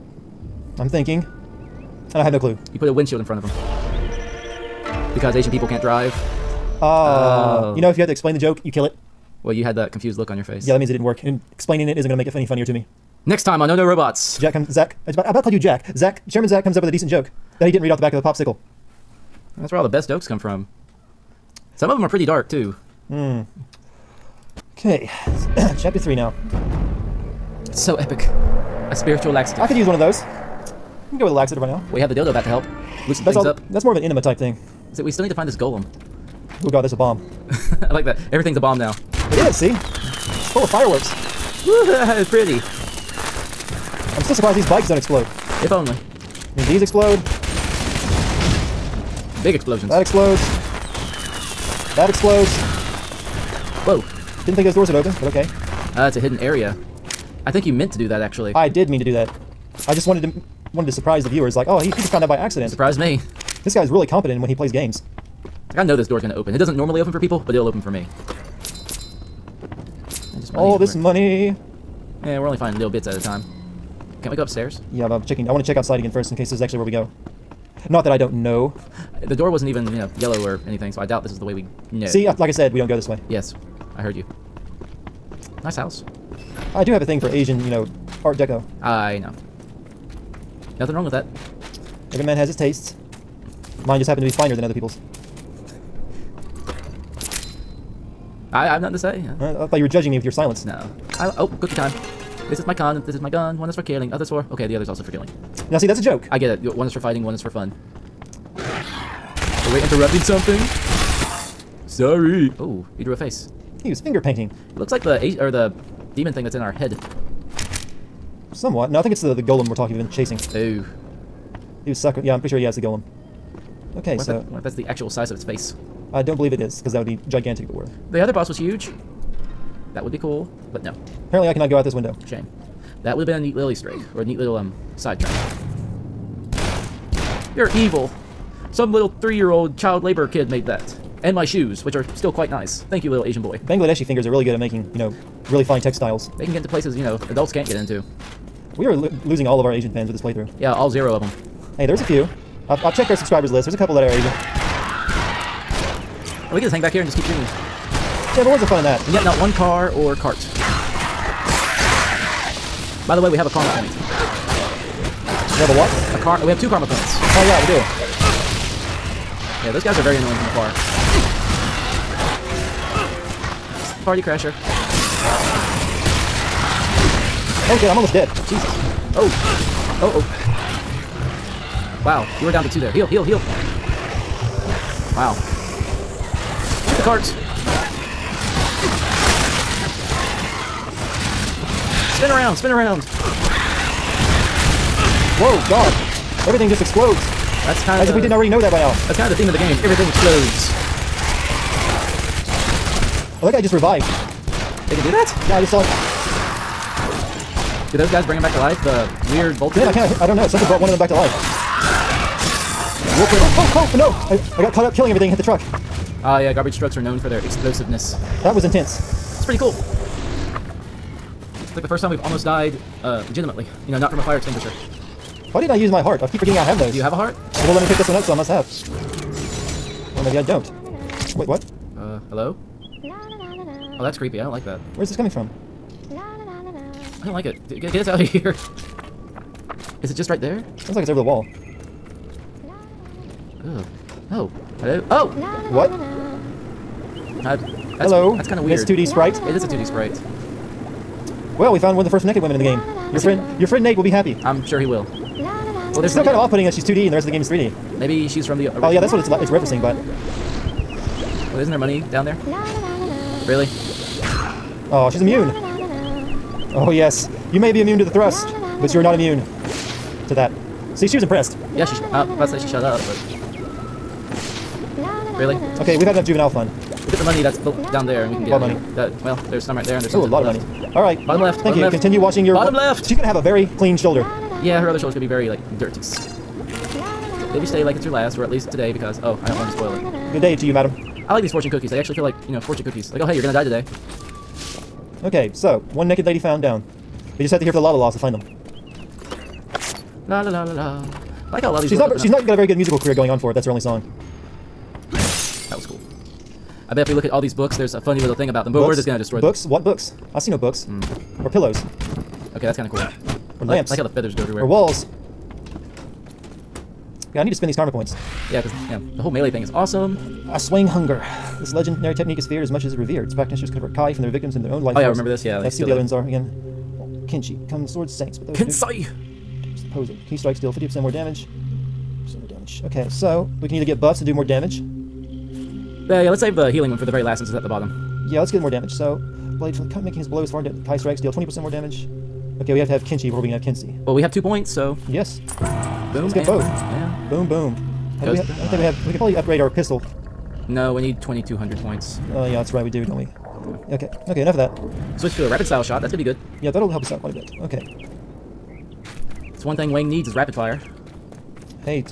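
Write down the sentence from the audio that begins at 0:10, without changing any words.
Yeah, that means it didn't work.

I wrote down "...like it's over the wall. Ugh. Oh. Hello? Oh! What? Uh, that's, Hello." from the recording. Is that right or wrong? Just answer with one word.
right.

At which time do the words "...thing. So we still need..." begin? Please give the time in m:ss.
0:34.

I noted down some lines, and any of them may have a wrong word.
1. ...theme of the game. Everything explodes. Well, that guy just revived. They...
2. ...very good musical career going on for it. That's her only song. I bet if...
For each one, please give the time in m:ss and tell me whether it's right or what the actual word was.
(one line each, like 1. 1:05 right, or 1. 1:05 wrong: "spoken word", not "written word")
1. 3:19 right
2. 5:02 right.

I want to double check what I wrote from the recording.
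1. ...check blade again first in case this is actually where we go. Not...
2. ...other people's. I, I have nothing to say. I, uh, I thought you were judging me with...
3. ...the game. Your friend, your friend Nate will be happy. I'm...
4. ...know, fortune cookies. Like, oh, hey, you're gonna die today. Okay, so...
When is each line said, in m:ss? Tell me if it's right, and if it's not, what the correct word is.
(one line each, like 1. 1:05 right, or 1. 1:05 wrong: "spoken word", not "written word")
1. 1:15 wrong: "outside", not "blade"
2. 1:34 right
3. 4:12 right
4. 4:52 right.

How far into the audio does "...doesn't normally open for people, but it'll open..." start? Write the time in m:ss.
1:06.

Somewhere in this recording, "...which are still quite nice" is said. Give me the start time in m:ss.
2:21.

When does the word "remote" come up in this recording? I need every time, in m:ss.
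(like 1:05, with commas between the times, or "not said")
not said.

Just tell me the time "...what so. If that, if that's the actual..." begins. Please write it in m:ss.
2:04.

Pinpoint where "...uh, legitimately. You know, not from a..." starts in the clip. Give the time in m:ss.
3:43.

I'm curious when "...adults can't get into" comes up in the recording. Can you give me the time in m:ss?
2:27.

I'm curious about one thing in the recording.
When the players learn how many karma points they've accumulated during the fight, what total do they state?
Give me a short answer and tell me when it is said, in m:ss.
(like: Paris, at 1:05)
2, at 2:46.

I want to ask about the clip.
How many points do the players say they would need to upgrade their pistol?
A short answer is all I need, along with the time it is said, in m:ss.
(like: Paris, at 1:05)
2,200, at 5:51.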